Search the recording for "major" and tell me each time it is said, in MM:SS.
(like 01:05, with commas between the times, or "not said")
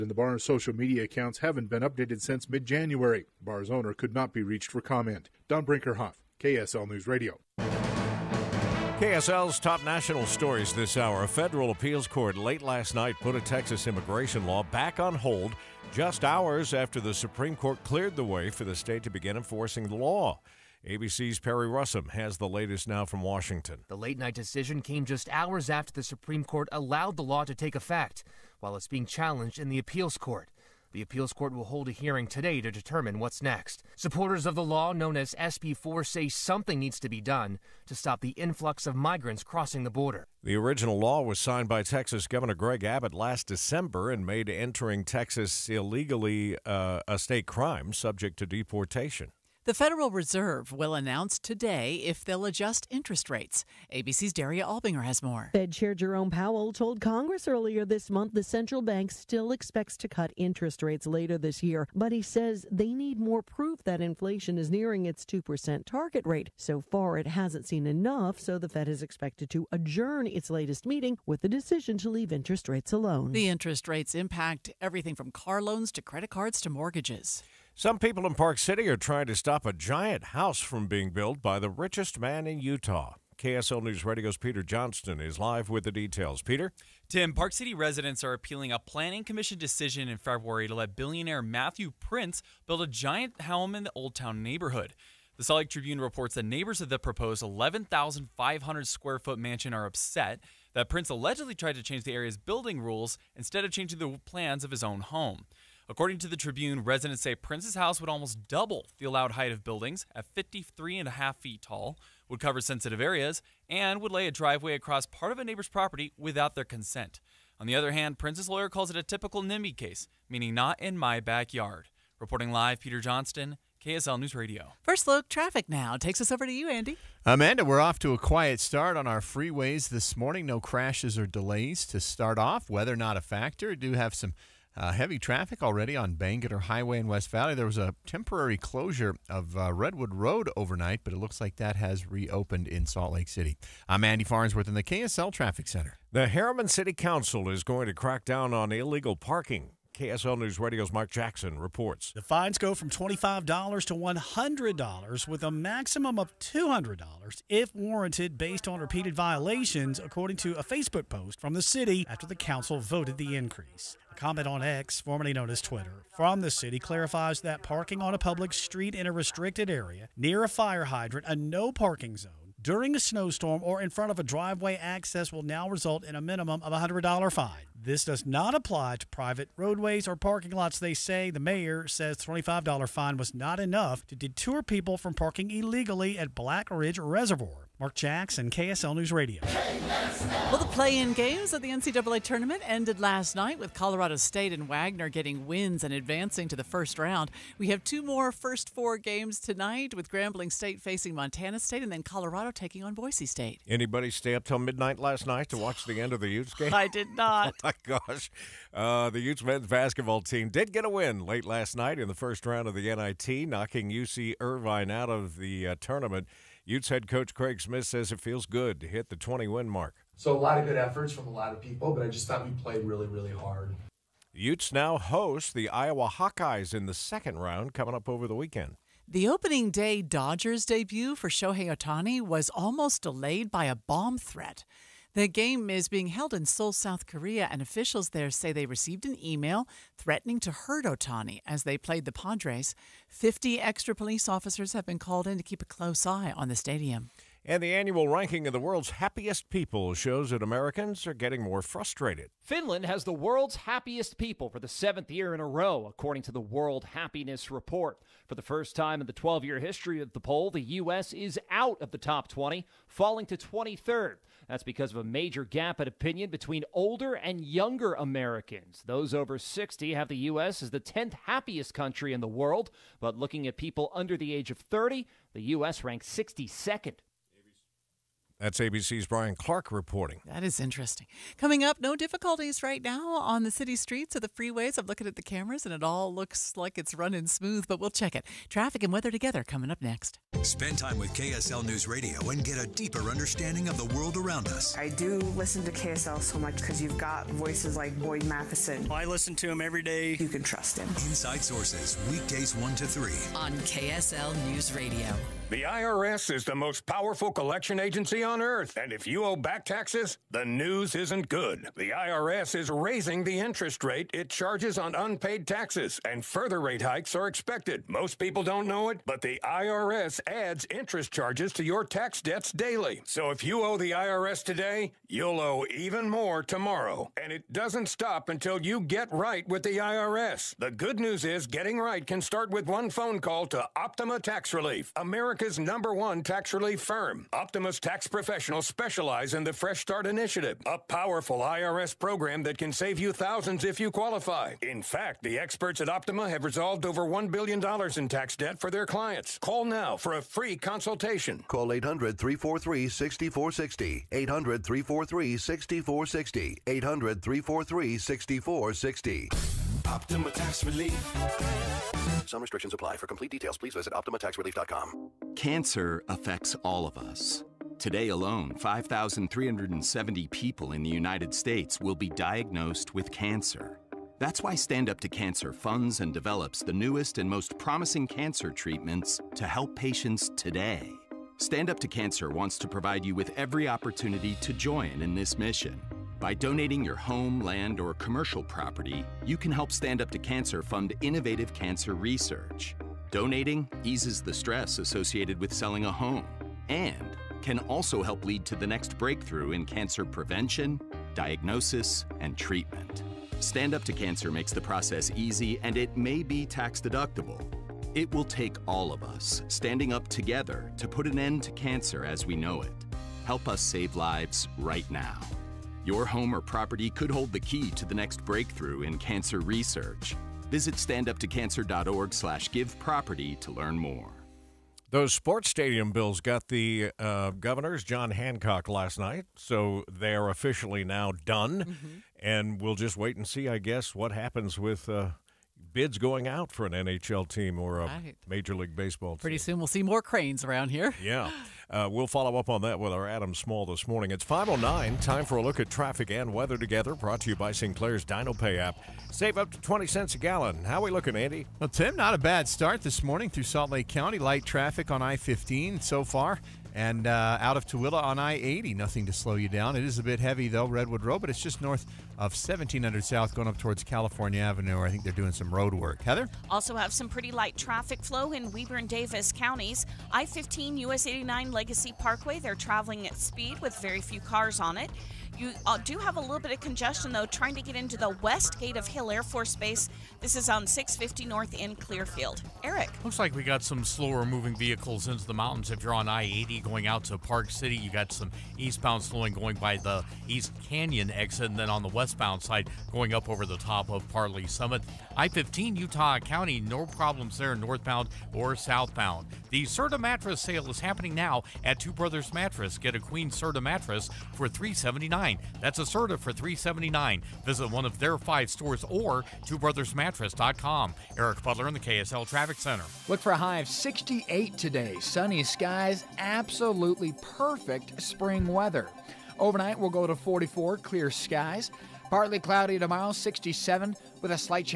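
04:25, 07:18.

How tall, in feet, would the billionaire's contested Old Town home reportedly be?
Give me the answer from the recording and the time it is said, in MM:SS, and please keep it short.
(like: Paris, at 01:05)
53 and a half, at 01:50.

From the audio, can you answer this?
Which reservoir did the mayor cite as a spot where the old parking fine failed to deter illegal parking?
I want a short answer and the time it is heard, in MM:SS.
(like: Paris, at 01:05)
Black Ridge Reservoir, at 03:06.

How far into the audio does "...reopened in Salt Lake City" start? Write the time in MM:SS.
02:22.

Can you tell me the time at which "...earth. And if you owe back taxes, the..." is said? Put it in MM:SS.
05:08.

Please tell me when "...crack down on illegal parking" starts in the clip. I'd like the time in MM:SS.
02:27.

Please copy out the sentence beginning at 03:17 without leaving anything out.
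We have two more first four games tonight with Grambling State facing Montana State and then Colorado taking on Boise State.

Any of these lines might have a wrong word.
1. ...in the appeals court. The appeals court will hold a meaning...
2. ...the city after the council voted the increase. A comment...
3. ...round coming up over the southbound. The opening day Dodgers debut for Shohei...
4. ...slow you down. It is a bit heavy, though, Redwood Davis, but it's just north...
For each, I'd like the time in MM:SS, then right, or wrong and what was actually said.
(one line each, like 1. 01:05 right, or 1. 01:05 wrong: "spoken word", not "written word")
1. 00:29 wrong: "hearing", not "meaning"
2. 02:41 right
3. 03:47 wrong: "weekend", not "southbound"
4. 07:39 wrong: "Road", not "Davis".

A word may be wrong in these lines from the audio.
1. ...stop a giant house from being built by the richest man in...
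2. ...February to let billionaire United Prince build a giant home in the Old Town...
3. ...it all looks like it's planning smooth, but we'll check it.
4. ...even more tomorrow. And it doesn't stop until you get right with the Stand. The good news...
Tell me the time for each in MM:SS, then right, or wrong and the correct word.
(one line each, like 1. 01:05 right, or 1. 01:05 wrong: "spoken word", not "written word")
1. 01:19 right
2. 01:30 wrong: "Matthew", not "United"
3. 04:45 wrong: "running", not "planning"
4. 05:25 wrong: "IRS", not "Stand".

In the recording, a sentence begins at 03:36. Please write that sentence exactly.
Utes head coach Craig Smith says it feels good to hit the 20 win mark.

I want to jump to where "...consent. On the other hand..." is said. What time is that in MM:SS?
01:56.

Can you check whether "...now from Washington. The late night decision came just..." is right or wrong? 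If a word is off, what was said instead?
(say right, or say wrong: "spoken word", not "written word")
right.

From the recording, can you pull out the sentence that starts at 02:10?
No crashes or delays to start off.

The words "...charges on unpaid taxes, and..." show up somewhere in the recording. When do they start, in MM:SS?
05:14.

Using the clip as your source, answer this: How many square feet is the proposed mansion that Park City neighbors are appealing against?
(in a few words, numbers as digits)
11,500.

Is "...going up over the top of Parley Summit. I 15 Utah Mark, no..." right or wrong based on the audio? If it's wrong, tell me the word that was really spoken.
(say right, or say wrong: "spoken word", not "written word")
wrong: "County", not "Mark".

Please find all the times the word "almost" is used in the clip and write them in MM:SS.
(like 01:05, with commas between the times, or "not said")
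01:48, 03:52.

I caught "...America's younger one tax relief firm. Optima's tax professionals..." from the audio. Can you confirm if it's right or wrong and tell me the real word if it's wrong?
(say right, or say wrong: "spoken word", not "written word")
wrong: "number", not "younger".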